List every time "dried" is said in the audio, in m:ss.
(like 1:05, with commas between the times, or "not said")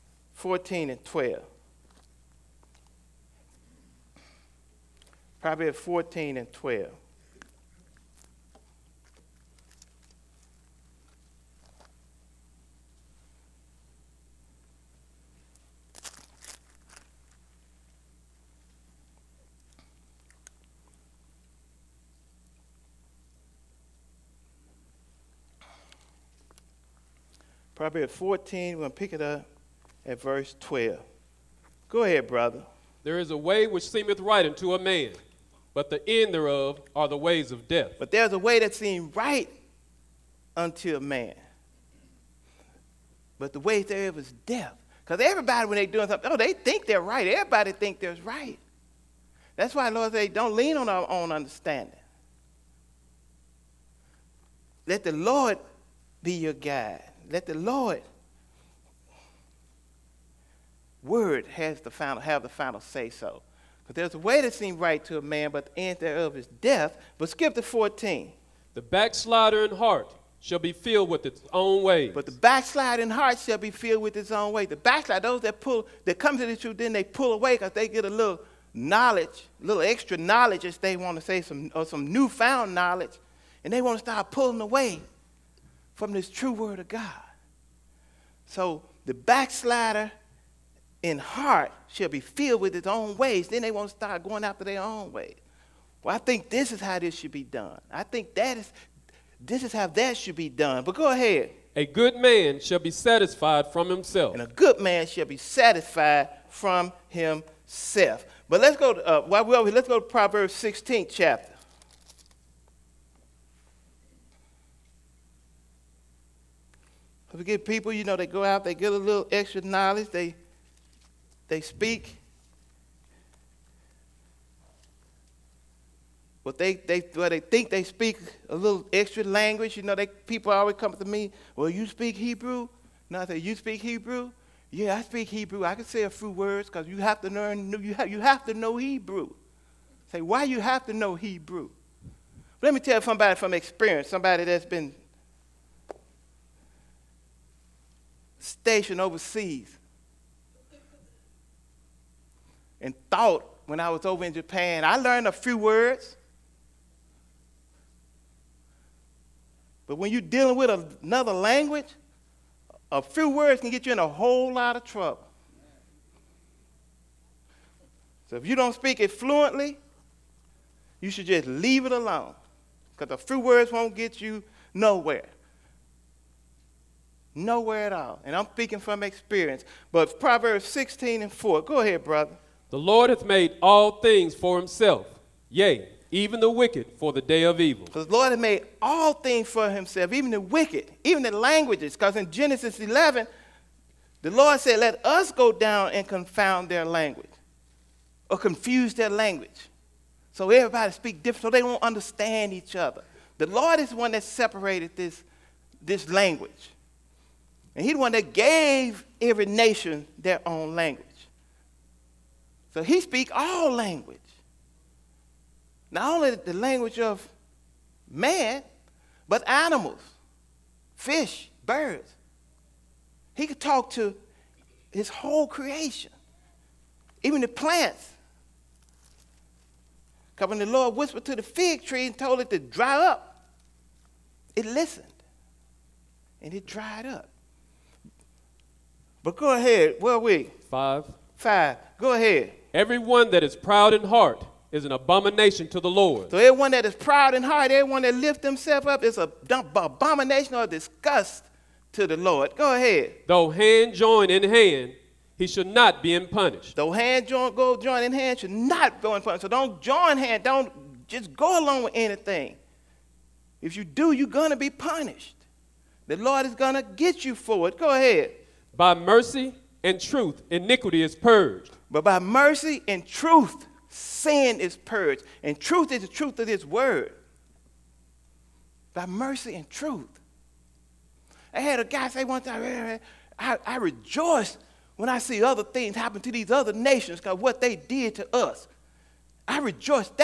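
3:56.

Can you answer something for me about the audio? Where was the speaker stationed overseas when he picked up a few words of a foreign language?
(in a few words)
Japan.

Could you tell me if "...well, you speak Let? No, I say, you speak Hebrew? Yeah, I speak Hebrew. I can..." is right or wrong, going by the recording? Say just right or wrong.
wrong.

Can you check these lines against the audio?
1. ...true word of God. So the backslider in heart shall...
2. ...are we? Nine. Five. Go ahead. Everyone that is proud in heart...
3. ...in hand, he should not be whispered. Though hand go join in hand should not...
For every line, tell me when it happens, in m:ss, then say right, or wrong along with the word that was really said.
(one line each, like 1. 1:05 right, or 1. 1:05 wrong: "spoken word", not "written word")
1. 1:26 right
2. 4:00 wrong: "Five", not "Nine"
3. 4:14 wrong: "punished", not "whispered".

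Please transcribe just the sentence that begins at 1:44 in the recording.
And a good man shall be satisfied from himself.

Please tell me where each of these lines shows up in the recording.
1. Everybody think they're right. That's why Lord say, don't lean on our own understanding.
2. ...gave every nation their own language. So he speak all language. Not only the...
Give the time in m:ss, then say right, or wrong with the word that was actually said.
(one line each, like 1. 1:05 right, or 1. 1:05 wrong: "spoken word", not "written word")
1. 0:47 right
2. 3:28 right.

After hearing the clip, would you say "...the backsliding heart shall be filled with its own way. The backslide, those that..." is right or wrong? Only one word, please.
right.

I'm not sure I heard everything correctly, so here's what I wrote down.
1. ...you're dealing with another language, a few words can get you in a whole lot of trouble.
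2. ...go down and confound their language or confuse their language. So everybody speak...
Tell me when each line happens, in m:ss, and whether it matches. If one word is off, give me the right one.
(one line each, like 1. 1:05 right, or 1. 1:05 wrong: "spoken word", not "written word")
1. 2:40 right
2. 3:15 right.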